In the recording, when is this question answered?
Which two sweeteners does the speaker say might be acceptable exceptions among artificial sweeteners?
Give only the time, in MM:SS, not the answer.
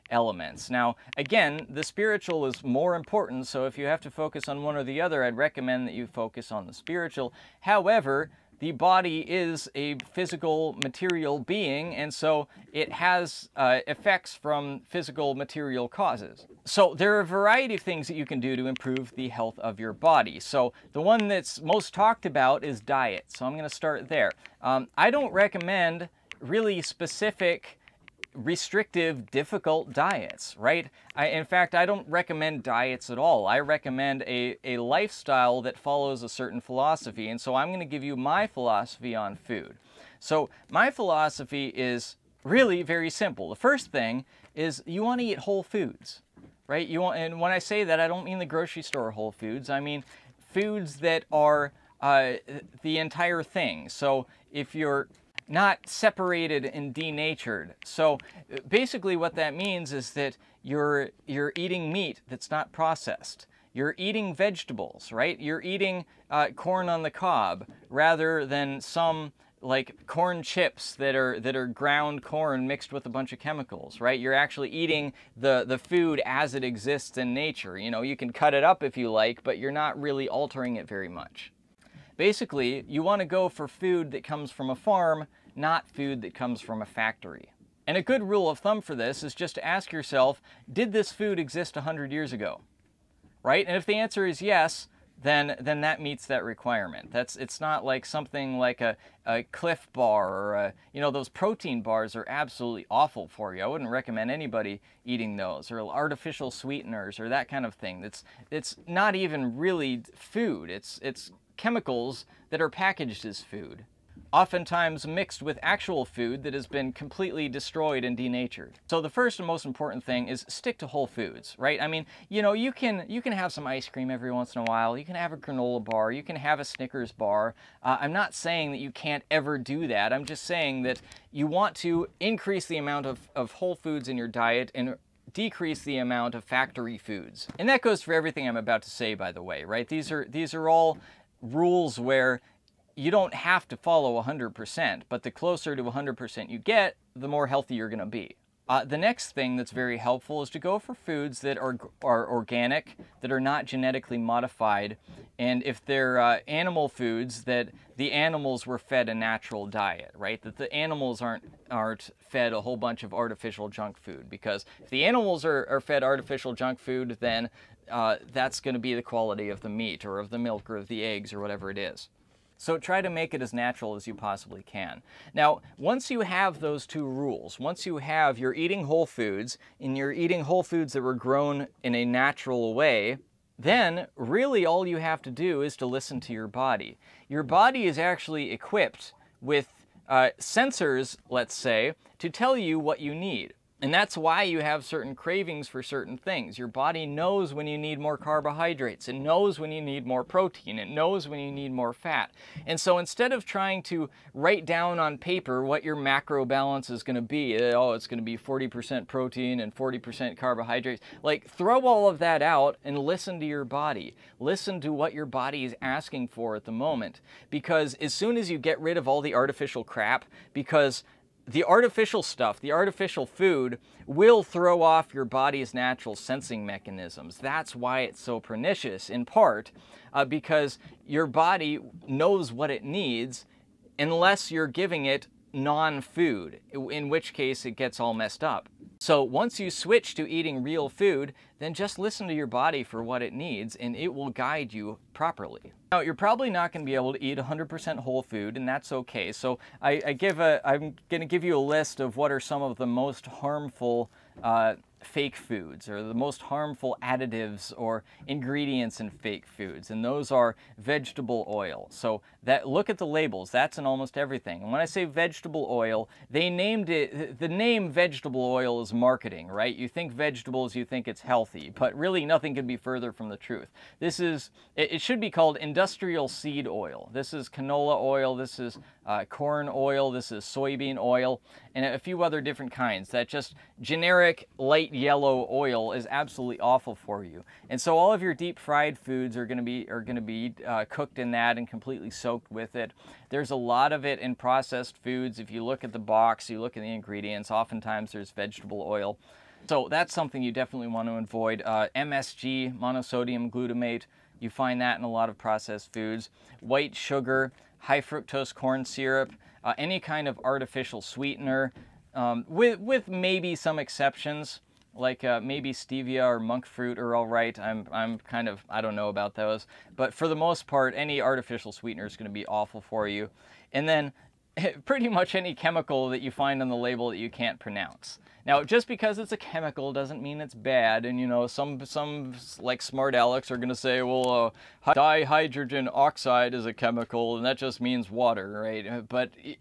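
05:15.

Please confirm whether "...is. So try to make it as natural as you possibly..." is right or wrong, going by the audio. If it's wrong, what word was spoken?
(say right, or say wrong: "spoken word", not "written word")
right.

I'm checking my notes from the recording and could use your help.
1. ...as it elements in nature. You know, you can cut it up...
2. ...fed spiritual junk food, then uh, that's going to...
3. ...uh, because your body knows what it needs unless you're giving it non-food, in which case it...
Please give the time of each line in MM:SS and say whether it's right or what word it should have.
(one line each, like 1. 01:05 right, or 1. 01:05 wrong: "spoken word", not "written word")
1. 01:16 wrong: "exists", not "elements"
2. 02:45 wrong: "artificial", not "spiritual"
3. 03:50 right.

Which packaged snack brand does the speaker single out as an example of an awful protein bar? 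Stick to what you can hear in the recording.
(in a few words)
Clif Bar.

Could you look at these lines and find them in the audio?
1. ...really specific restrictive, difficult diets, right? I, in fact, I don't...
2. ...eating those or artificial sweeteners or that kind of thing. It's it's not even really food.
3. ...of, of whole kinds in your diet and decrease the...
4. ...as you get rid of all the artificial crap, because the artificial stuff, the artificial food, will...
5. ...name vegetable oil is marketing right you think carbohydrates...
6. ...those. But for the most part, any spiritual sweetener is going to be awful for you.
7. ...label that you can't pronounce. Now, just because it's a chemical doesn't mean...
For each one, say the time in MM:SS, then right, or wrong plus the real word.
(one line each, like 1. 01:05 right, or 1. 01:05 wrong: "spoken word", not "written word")
1. 00:26 right
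2. 01:45 right
3. 02:13 wrong: "foods", not "kinds"
4. 03:38 right
5. 04:27 wrong: "vegetables", not "carbohydrates"
6. 05:19 wrong: "artificial", not "spiritual"
7. 05:26 right.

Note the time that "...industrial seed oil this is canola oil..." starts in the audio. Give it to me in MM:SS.
04:35.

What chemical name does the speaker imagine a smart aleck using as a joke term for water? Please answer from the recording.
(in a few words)
dihydrogen oxide.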